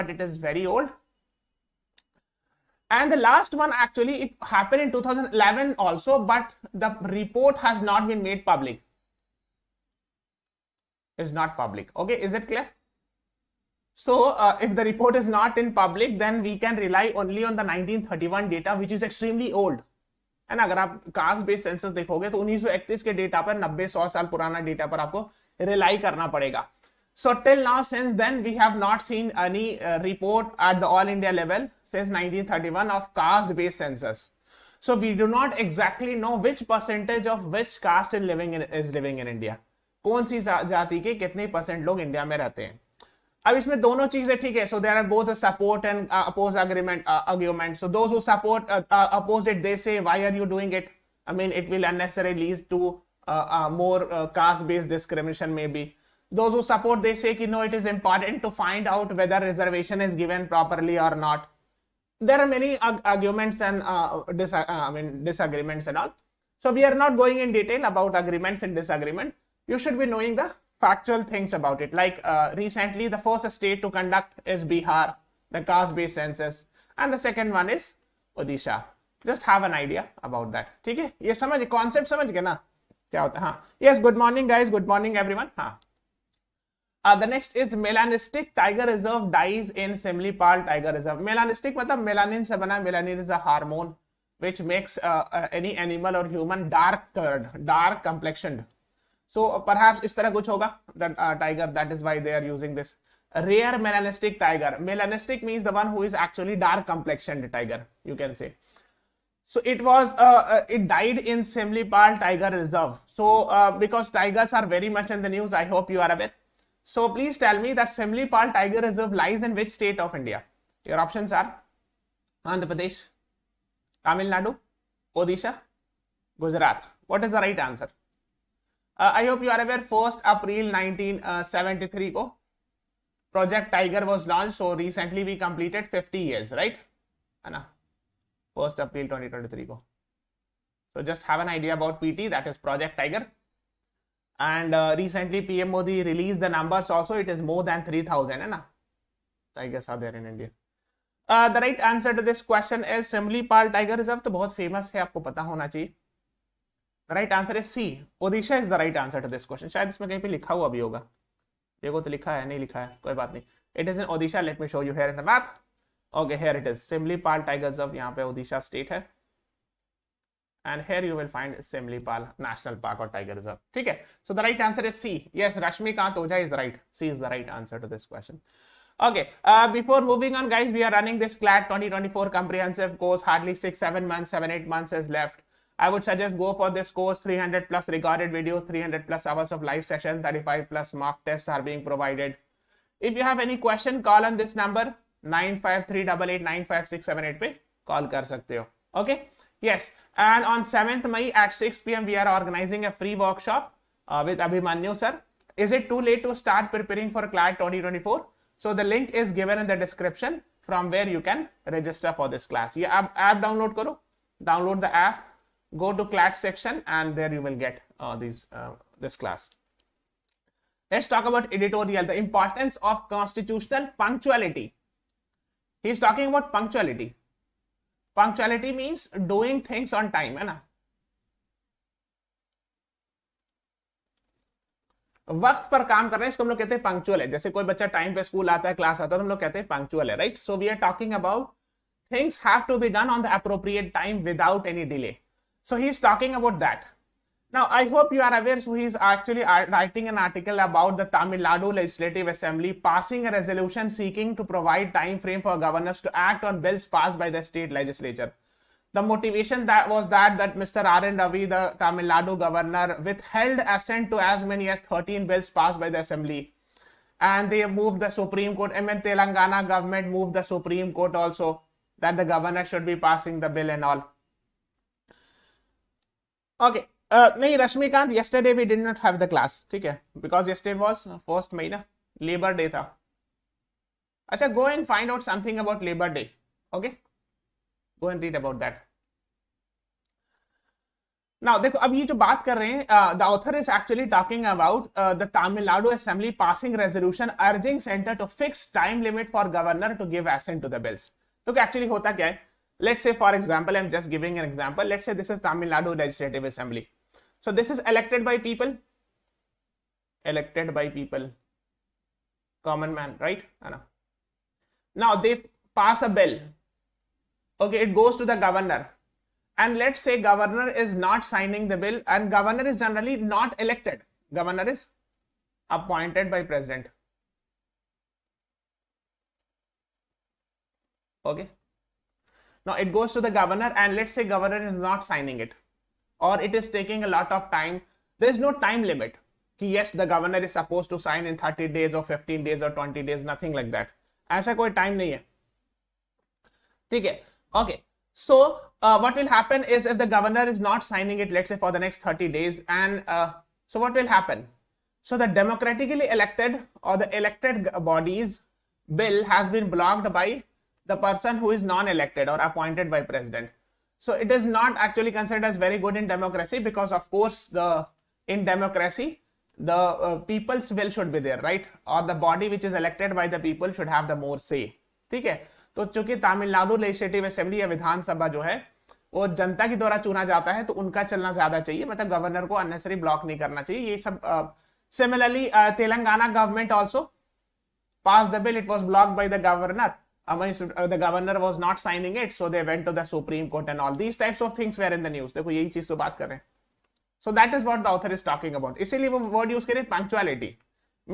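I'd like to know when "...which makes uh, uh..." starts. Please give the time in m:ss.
1:34.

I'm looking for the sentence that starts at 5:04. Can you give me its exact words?
Let's say this is Tamil Nadu Legislative Assembly.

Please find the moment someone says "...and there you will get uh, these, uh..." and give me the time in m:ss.
3:36.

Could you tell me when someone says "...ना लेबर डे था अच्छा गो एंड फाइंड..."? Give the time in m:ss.
4:41.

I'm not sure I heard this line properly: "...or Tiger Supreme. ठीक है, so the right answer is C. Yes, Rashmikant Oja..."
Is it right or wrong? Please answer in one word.
wrong.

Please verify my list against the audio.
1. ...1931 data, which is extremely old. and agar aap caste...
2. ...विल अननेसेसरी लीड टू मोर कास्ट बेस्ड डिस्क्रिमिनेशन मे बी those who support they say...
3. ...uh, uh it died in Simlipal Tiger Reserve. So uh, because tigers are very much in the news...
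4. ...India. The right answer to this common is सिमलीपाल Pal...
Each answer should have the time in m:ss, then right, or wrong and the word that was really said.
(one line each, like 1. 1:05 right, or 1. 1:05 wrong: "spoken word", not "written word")
1. 0:17 right
2. 0:51 right
3. 1:50 right
4. 2:30 wrong: "question", not "common".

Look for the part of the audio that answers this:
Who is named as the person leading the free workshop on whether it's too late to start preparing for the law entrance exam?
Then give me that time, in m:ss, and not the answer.
3:24.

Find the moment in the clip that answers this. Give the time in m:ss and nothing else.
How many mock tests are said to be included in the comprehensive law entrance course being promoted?
3:10.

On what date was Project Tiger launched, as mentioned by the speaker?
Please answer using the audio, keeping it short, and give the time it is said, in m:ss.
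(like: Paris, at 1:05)
1st April 1973, at 2:09.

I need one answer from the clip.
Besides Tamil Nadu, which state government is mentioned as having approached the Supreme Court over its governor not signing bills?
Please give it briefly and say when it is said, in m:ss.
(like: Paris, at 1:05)
Telangana, at 4:28.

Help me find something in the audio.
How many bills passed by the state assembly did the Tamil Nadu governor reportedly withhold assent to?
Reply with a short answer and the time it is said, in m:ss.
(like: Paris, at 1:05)
13, at 4:24.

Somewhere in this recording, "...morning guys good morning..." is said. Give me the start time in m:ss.
1:24.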